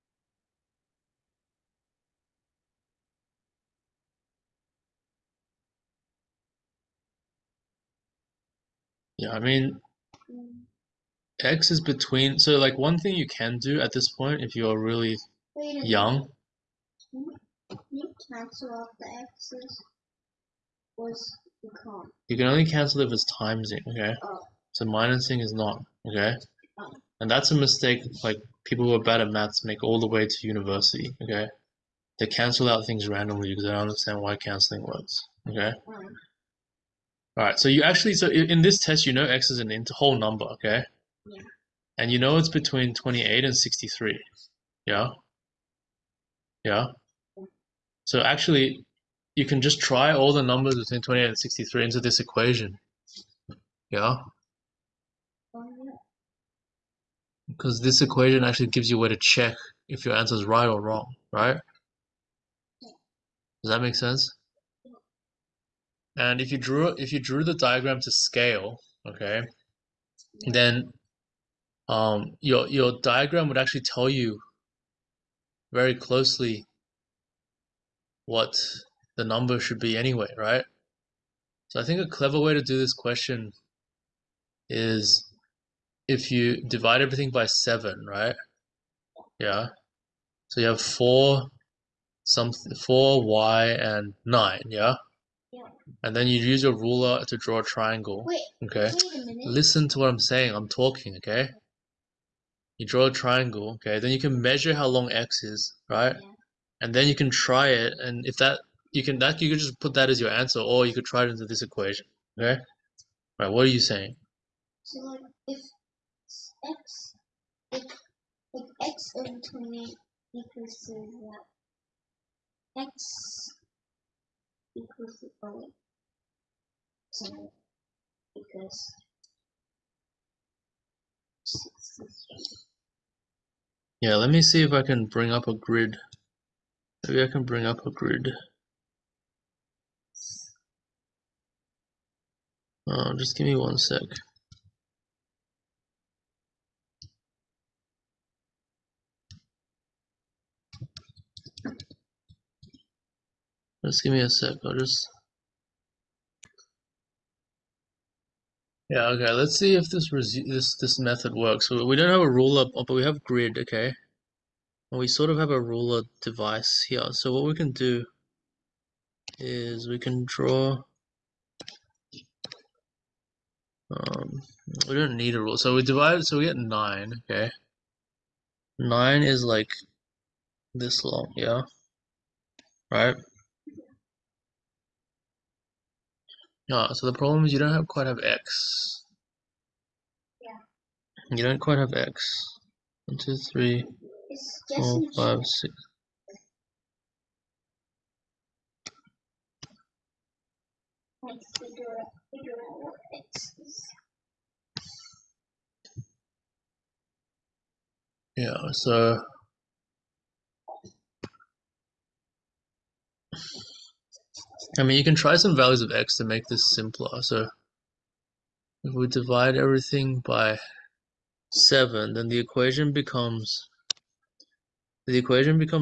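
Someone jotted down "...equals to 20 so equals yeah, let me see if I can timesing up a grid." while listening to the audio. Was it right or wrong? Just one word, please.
wrong.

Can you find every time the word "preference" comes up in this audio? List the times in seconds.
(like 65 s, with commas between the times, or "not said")
not said.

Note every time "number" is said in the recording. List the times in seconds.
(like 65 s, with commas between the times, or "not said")
40 s, 50 s, 79 s.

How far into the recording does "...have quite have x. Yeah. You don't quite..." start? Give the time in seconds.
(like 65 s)
187 s.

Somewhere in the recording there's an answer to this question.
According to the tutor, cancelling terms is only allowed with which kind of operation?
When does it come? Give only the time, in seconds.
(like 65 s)
23 s.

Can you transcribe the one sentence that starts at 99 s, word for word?
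Wait Listen to what I'm saying.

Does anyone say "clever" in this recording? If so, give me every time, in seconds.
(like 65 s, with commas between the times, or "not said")
82 s.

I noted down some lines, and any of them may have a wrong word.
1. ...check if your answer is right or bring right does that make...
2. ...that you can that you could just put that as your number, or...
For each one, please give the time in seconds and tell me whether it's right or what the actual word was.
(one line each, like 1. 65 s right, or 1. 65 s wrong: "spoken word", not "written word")
1. 59 s wrong: "wrong", not "bring"
2. 108 s wrong: "answer", not "number".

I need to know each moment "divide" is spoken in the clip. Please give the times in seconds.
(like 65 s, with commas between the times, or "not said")
86 s, 175 s, 219 s.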